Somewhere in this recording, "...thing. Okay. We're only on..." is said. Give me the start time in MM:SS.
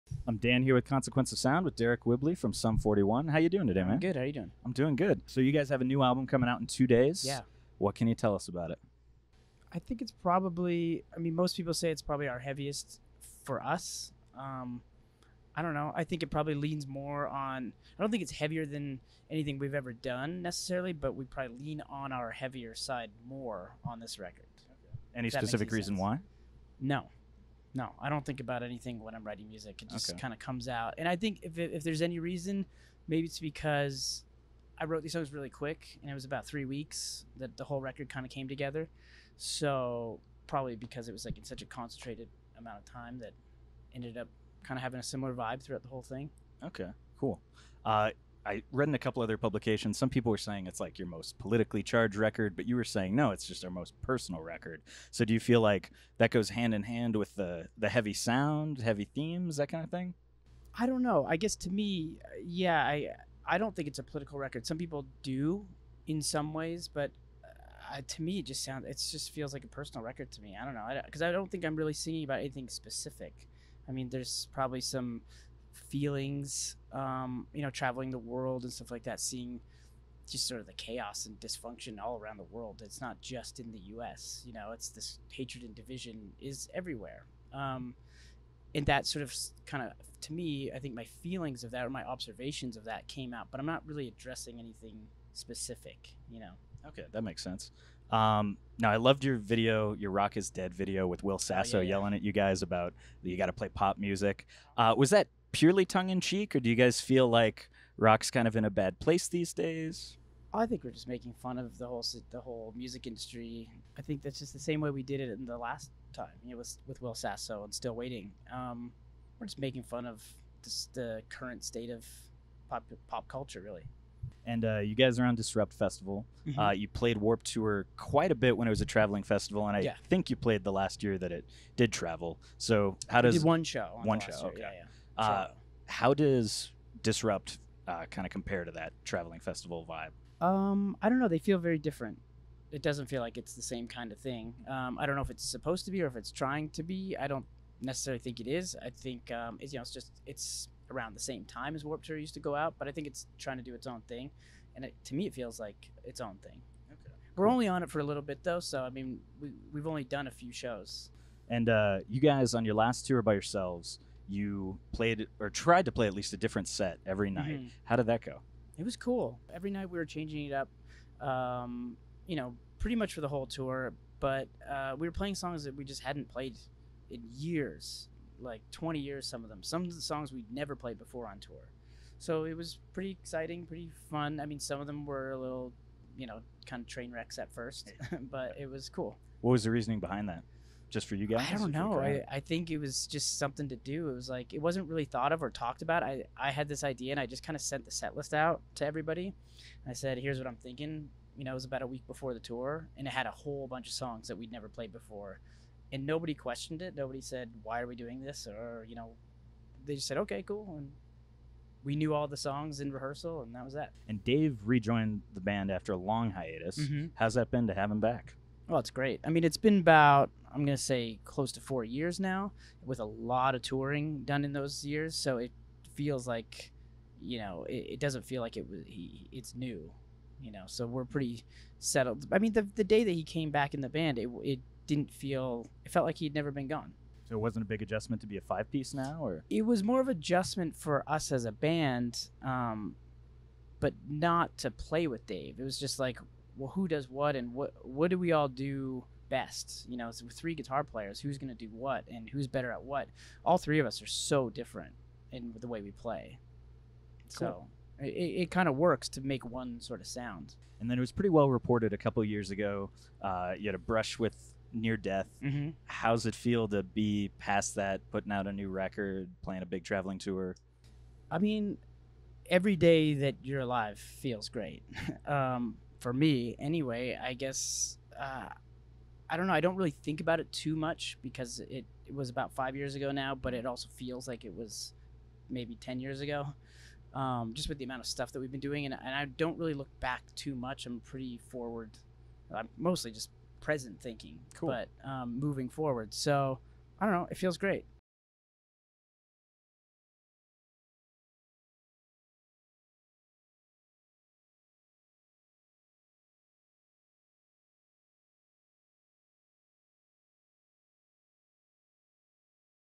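02:36.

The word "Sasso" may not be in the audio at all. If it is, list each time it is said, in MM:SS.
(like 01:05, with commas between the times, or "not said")
01:41, 01:57.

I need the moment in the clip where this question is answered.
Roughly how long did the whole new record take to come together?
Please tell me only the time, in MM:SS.
00:36.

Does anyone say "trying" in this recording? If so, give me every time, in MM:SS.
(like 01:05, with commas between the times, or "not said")
02:26, 02:33.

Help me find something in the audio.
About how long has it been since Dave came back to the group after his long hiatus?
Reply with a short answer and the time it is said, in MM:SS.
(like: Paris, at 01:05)
close to 4 years, at 03:41.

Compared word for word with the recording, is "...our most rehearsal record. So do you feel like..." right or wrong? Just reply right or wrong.
wrong.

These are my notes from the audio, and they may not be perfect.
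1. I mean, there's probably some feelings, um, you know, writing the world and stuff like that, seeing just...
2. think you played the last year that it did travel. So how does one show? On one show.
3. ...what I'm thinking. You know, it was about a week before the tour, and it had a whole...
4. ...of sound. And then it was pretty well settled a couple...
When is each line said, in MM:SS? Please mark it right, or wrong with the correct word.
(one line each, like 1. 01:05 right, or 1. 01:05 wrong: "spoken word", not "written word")
1. 01:13 wrong: "traveling", not "writing"
2. 02:10 right
3. 03:20 right
4. 04:20 wrong: "reported", not "settled".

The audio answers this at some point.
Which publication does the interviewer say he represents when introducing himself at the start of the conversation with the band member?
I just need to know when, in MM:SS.
00:00.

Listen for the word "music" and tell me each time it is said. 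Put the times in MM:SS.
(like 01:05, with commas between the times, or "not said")
00:29, 01:43, 01:52.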